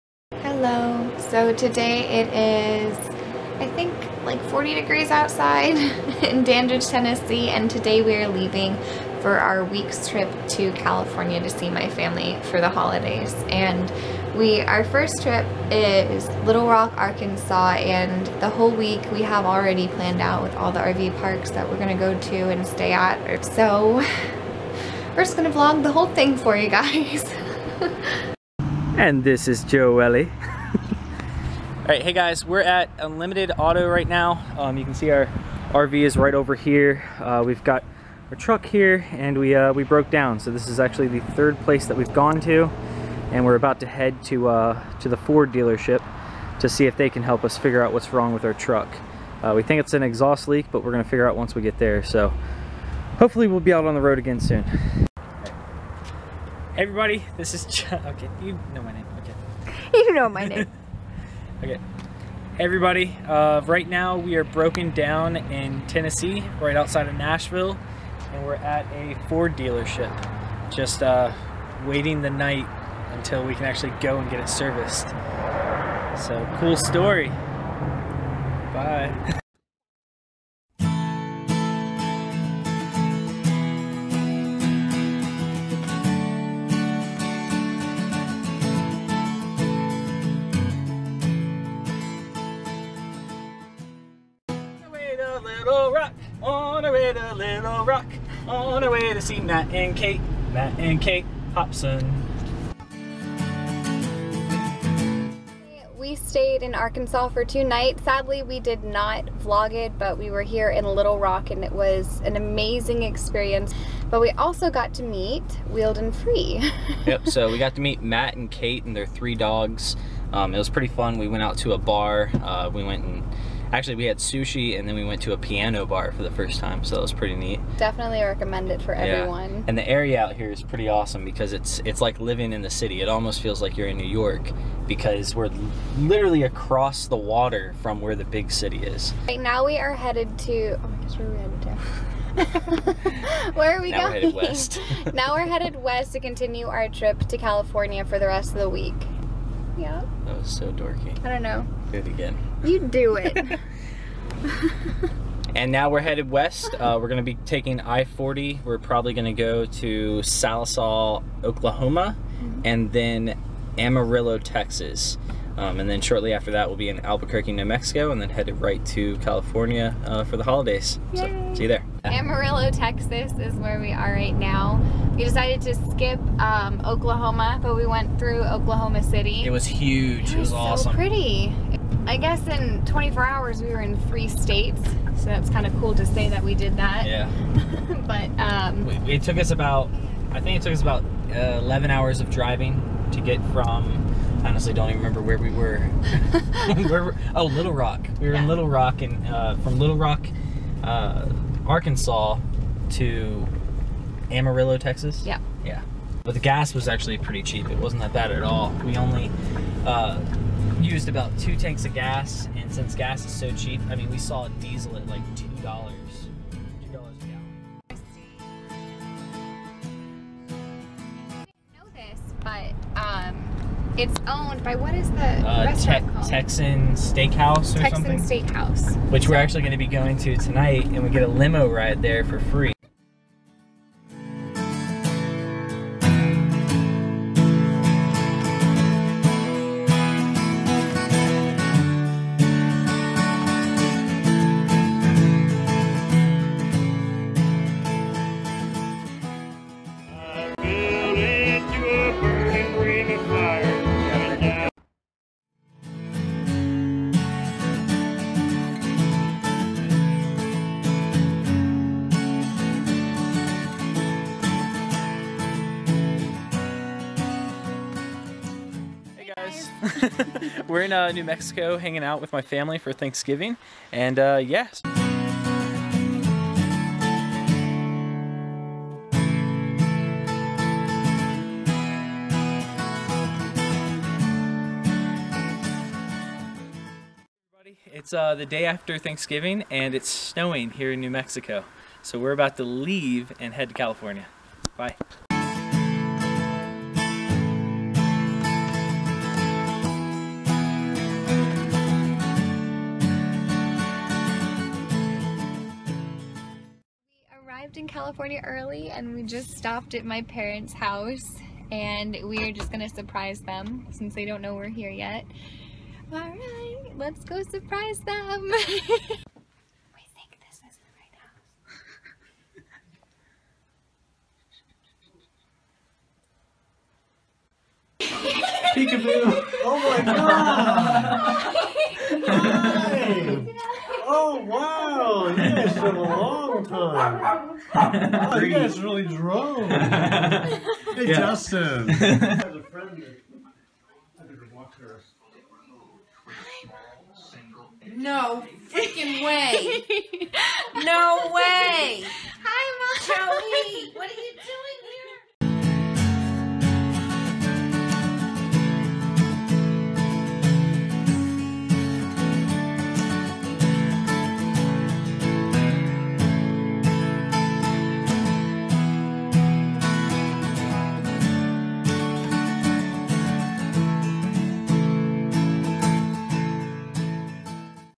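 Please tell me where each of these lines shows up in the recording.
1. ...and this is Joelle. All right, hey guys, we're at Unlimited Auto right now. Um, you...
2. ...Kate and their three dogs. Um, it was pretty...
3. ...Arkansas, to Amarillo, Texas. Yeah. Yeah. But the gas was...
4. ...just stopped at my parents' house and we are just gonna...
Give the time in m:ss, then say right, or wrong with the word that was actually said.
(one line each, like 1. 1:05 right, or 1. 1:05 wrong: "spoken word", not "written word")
1. 0:28 right
2. 1:58 right
3. 3:21 right
4. 5:09 right.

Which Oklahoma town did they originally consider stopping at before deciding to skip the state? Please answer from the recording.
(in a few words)
Sallisaw.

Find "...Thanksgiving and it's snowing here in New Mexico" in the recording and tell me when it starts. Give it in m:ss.
4:48.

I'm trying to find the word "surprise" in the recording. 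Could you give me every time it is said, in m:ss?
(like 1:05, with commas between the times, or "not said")
5:12, 5:17.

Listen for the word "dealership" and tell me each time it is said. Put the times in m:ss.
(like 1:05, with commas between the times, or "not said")
0:45, 1:09.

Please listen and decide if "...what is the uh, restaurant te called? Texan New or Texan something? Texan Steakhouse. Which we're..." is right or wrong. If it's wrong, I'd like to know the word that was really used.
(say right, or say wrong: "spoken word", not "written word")
wrong: "Steakhouse", not "New".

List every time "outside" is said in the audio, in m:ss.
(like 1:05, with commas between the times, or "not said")
0:05, 1:06.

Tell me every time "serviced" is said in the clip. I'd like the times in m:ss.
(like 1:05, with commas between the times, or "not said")
1:14.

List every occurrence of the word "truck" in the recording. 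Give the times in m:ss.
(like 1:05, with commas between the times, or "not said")
0:38, 0:48.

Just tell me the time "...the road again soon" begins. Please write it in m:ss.
0:53.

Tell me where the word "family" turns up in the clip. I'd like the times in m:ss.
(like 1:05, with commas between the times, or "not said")
0:11, 4:32.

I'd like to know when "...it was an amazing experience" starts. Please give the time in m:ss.
1:51.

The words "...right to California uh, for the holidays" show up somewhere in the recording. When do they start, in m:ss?
2:48.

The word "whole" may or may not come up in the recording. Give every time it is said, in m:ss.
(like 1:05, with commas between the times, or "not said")
0:18, 0:25.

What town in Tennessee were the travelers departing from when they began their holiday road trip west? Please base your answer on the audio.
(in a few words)
Dandridge.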